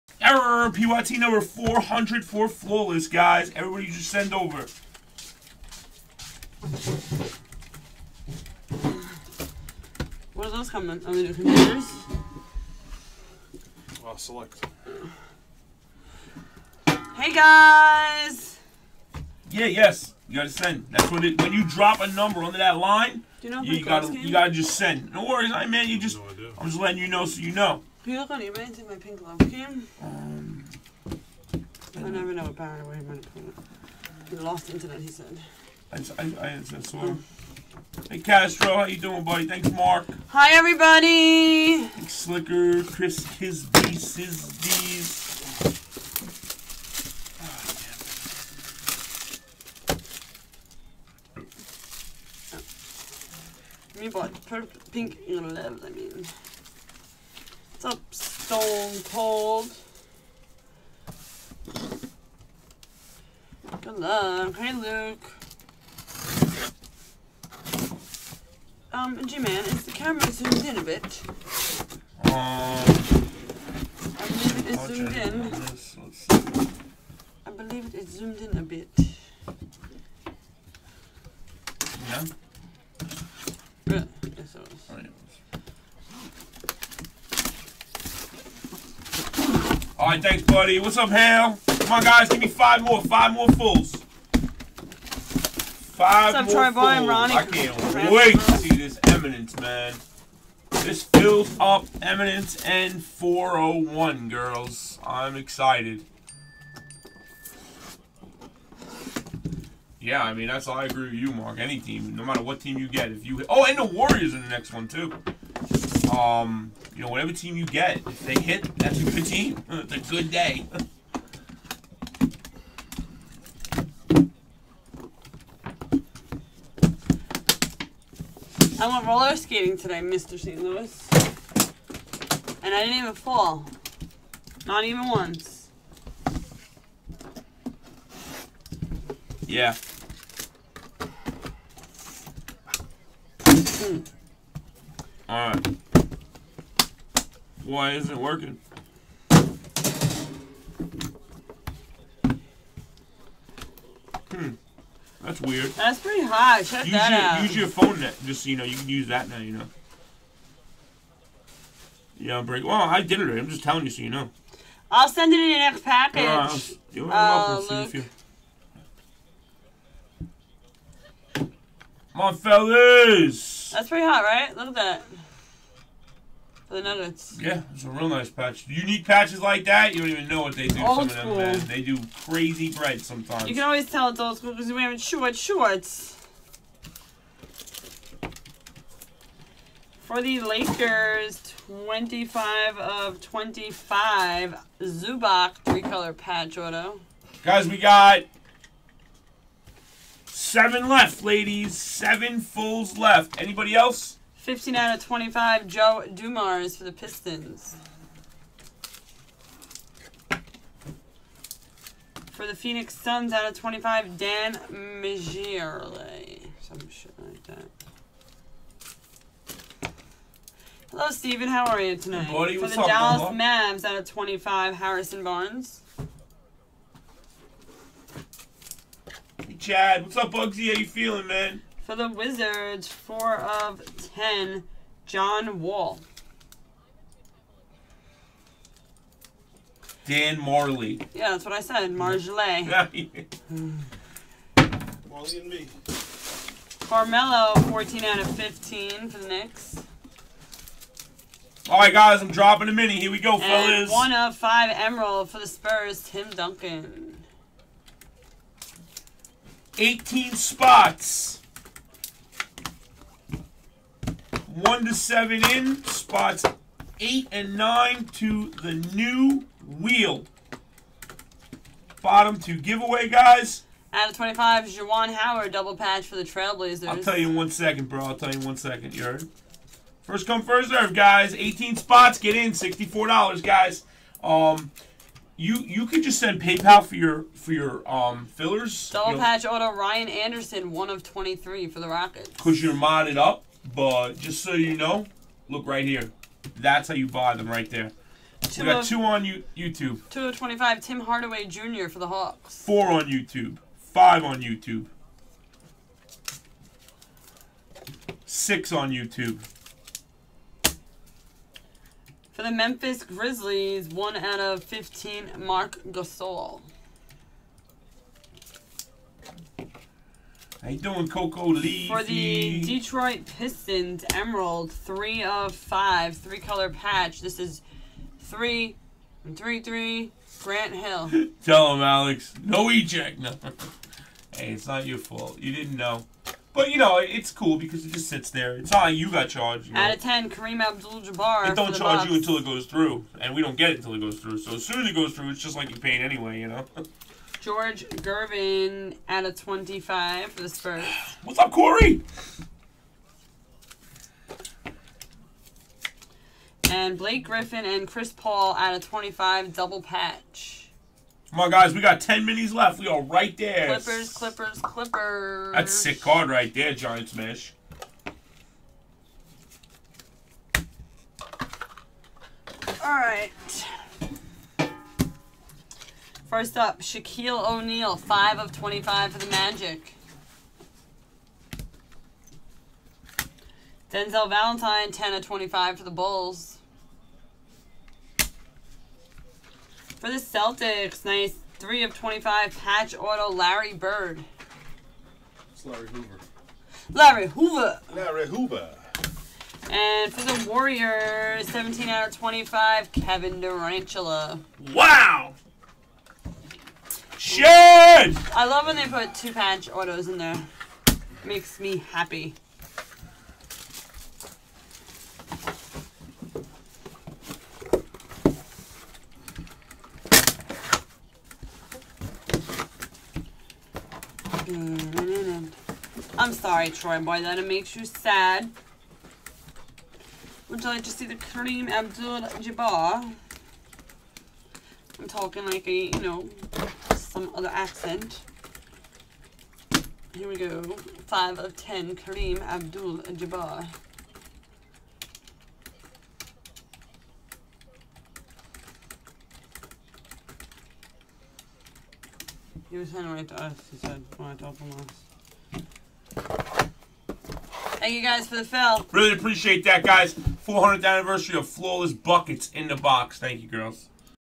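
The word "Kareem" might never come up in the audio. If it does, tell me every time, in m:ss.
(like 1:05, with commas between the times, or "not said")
5:40, 7:11, 7:21.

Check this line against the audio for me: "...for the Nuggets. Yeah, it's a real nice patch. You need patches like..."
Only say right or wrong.
right.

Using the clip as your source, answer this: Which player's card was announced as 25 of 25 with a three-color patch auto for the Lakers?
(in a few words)
Zubac.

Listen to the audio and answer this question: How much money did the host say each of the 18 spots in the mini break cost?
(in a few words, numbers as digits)
$64.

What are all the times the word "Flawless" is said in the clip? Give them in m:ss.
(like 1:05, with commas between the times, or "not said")
0:02, 7:41.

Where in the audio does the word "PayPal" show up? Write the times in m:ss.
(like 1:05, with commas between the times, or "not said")
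4:46.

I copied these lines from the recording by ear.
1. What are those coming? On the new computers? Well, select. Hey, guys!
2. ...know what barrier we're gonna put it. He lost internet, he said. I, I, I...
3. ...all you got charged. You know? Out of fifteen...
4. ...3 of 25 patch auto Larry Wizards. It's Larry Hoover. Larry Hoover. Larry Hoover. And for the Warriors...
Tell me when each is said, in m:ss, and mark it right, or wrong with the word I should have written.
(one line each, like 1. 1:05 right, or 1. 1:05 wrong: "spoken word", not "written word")
1. 0:10 right
2. 0:32 right
3. 5:38 wrong: "ten", not "fifteen"
4. 6:31 wrong: "Bird", not "Wizards".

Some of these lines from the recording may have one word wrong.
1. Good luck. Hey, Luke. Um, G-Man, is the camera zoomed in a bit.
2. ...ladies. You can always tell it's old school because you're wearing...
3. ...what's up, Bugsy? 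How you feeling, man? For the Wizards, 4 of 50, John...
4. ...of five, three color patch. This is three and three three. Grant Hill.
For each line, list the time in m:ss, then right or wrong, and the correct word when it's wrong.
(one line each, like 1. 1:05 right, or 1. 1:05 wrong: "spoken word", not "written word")
1. 1:03 right
2. 3:03 wrong: "sometimes", not "ladies"
3. 3:50 wrong: "10", not "50"
4. 5:25 right.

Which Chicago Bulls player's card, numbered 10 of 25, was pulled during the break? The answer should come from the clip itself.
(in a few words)
Denzel Valentine.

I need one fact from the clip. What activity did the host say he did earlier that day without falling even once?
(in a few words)
roller skating.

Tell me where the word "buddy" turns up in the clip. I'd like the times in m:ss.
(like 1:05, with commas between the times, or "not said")
0:39, 1:30, 3:42.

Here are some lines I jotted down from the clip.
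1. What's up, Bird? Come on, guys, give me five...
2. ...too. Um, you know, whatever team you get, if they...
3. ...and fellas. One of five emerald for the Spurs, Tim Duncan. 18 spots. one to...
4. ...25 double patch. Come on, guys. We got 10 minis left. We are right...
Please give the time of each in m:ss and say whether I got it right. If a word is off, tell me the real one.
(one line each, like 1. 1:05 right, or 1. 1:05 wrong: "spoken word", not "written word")
1. 1:30 wrong: "Ham", not "Bird"
2. 1:54 right
3. 4:13 right
4. 5:58 right.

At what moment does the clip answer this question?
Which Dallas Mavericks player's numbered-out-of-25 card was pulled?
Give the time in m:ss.
3:44.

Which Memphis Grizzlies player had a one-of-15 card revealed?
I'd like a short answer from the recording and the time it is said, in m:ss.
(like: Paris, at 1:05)
Marc Gasol, at 5:15.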